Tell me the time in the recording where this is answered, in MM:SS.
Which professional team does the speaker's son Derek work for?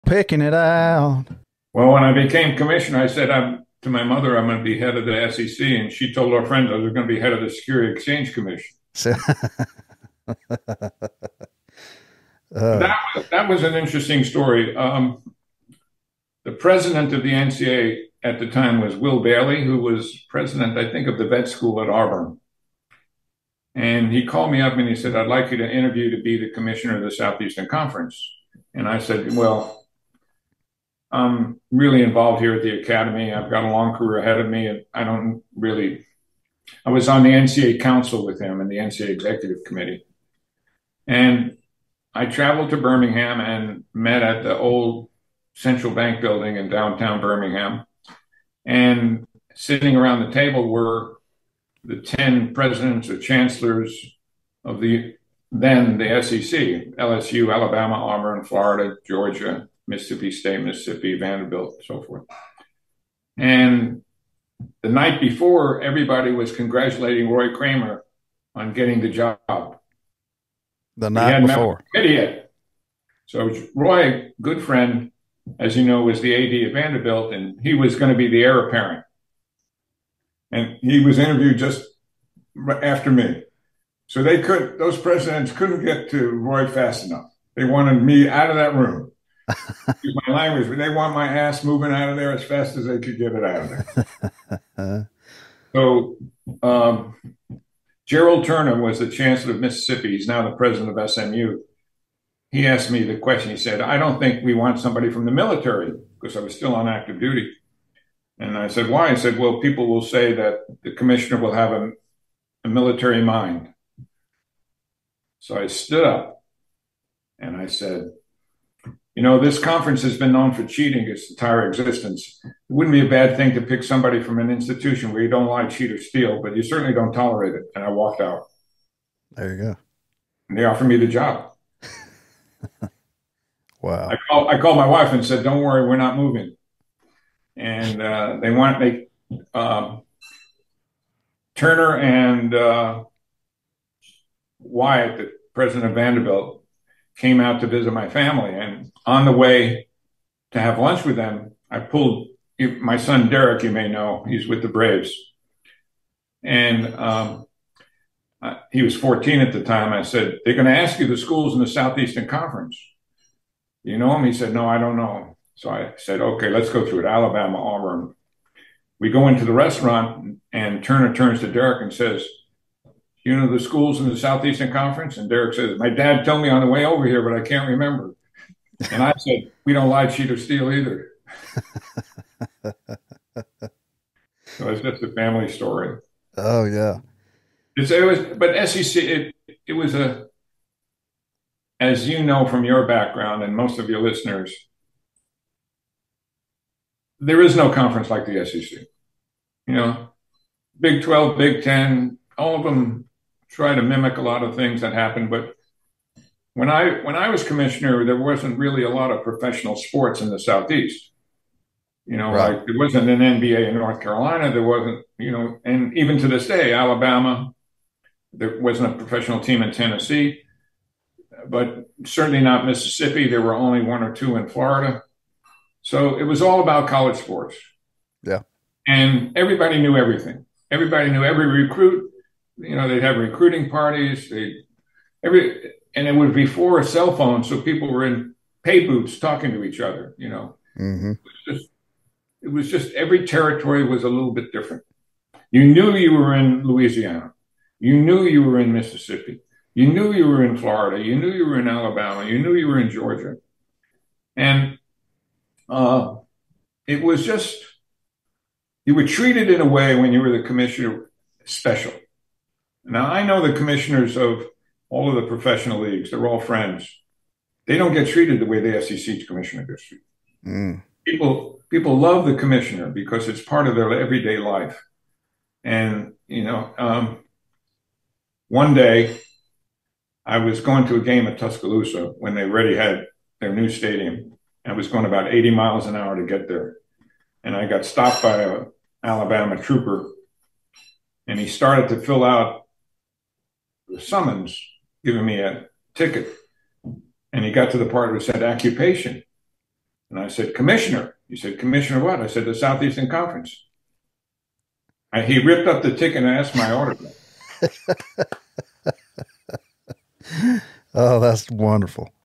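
02:34.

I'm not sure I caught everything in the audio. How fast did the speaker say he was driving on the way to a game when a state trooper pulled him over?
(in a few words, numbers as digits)
80 miles an hour.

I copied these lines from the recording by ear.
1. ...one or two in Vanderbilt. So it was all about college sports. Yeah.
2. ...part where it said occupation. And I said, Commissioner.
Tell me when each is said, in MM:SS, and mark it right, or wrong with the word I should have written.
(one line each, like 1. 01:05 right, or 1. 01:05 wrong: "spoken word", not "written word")
1. 03:43 wrong: "Florida", not "Vanderbilt"
2. 04:57 right.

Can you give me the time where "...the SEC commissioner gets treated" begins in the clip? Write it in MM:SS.
04:28.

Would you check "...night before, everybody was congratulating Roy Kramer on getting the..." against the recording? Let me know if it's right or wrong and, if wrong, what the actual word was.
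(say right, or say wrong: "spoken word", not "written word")
right.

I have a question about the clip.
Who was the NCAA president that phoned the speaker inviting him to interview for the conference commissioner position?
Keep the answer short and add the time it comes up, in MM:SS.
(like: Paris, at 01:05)
Will Bailey, at 00:18.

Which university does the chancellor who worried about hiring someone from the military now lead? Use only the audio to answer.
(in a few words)
SMU.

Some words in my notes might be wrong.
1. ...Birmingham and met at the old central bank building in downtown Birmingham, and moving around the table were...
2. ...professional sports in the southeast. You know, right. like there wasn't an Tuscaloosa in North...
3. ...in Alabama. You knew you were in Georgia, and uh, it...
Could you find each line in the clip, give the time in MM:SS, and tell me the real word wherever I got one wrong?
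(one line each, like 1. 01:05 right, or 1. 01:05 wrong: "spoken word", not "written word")
1. 00:42 wrong: "sitting", not "moving"
2. 03:29 wrong: "NBA", not "Tuscaloosa"
3. 04:11 right.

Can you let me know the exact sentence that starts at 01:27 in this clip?
They wanted me out of that room.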